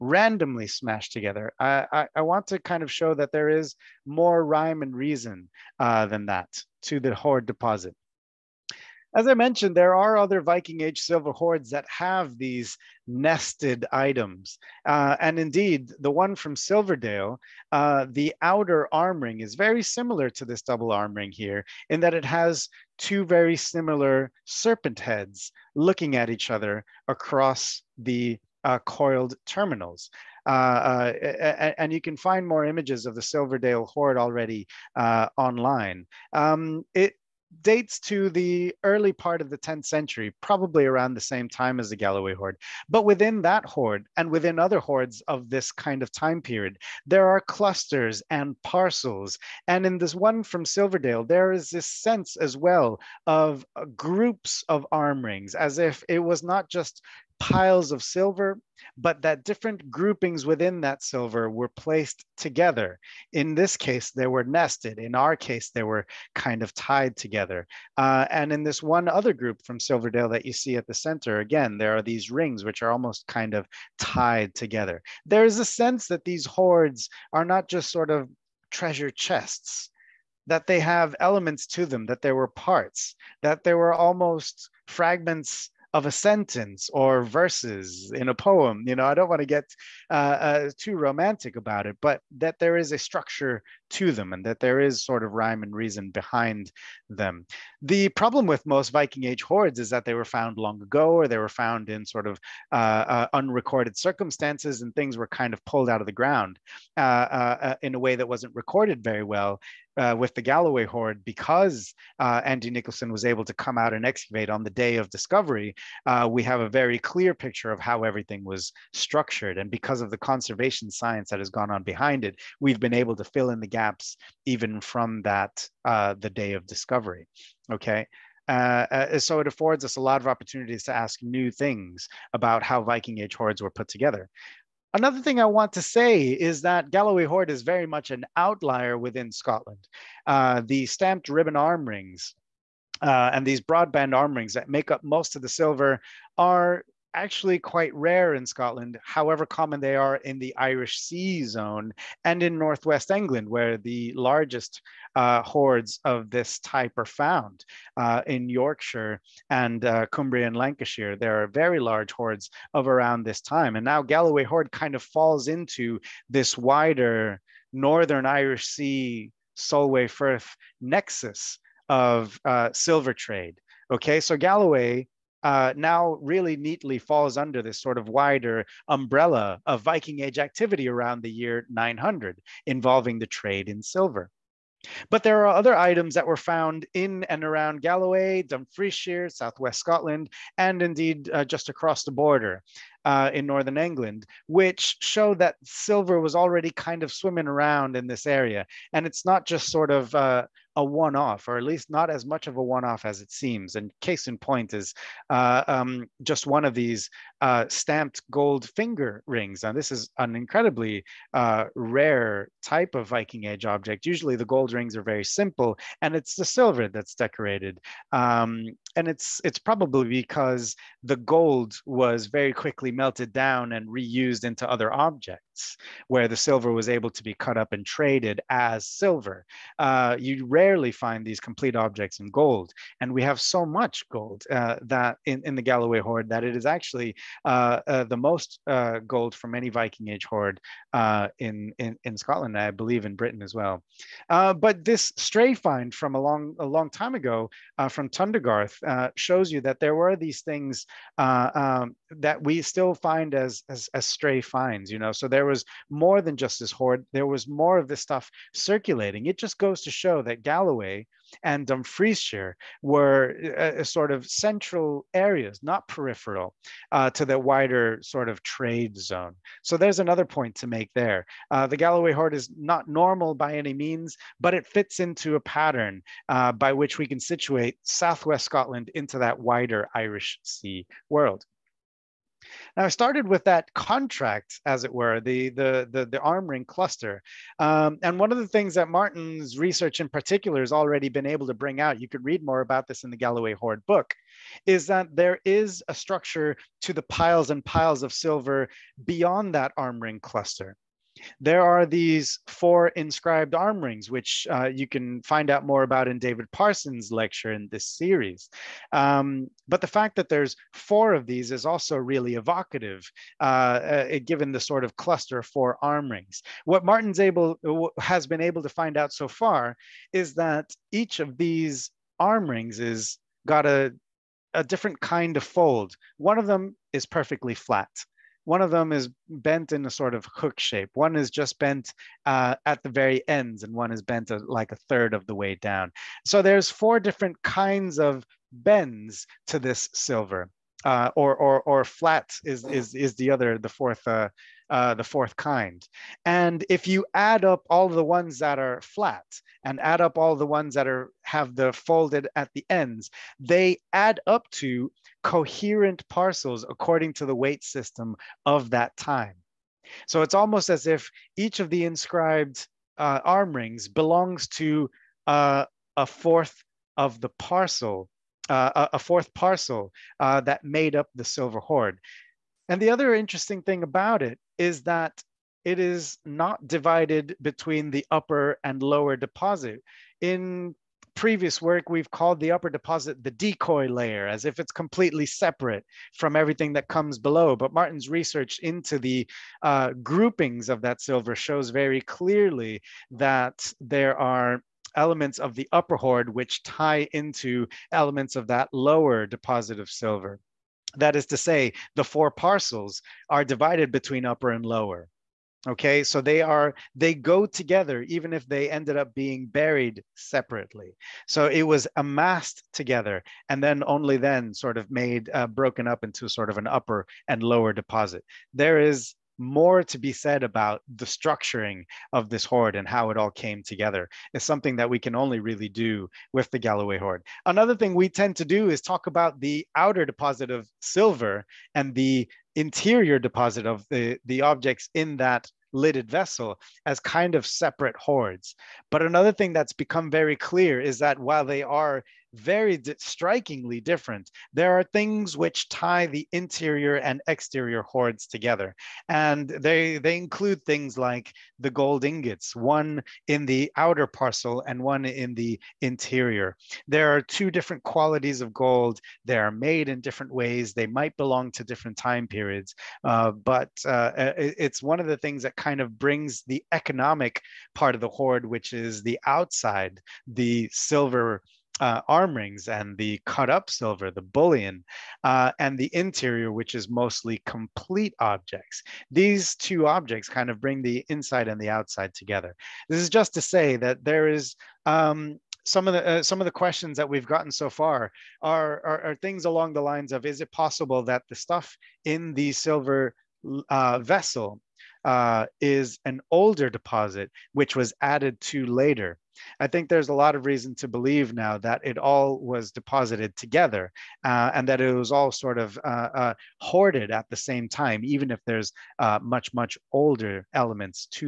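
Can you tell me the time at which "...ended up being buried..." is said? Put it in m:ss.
6:48.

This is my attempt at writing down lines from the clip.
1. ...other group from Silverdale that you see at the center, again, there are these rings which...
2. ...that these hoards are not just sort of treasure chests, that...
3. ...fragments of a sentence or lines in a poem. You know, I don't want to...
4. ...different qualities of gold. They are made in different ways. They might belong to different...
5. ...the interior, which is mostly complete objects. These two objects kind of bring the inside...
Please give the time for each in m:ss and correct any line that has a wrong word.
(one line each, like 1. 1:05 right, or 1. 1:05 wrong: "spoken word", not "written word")
1. 1:09 right
2. 1:16 right
3. 1:24 wrong: "verses", not "lines"
4. 7:37 right
5. 7:55 right.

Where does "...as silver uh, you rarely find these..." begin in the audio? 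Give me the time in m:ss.
3:48.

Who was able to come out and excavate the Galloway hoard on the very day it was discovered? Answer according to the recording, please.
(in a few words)
Andy Nicholson.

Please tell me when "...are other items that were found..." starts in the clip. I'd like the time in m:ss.
3:05.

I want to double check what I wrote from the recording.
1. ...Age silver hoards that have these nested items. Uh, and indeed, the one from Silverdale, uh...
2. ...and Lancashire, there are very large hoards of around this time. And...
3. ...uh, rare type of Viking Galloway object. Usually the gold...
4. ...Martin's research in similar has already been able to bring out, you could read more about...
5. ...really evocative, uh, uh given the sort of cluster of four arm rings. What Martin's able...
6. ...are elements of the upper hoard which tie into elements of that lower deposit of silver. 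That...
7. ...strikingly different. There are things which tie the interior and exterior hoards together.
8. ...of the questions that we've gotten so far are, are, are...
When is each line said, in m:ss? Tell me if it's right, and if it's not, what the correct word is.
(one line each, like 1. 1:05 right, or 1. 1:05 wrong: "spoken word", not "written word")
1. 0:10 right
2. 2:40 right
3. 3:31 wrong: "Age", not "Galloway"
4. 4:48 wrong: "particular", not "similar"
5. 5:11 right
6. 6:34 right
7. 7:22 right
8. 8:06 right.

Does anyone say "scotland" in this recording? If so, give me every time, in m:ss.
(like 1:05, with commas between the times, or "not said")
2:19, 2:28, 3:09, 4:02, 4:38.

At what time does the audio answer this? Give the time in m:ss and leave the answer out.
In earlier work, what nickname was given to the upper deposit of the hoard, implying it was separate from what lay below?
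6:23.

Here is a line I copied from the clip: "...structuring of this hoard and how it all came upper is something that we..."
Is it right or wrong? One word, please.
wrong.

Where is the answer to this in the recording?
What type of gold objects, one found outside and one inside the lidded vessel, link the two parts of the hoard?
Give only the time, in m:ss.
7:31.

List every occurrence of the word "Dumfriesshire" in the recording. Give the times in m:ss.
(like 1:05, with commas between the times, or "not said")
3:08, 4:21.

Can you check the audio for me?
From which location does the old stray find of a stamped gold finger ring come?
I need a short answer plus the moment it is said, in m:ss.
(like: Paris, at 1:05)
Tundergarth, at 4:08.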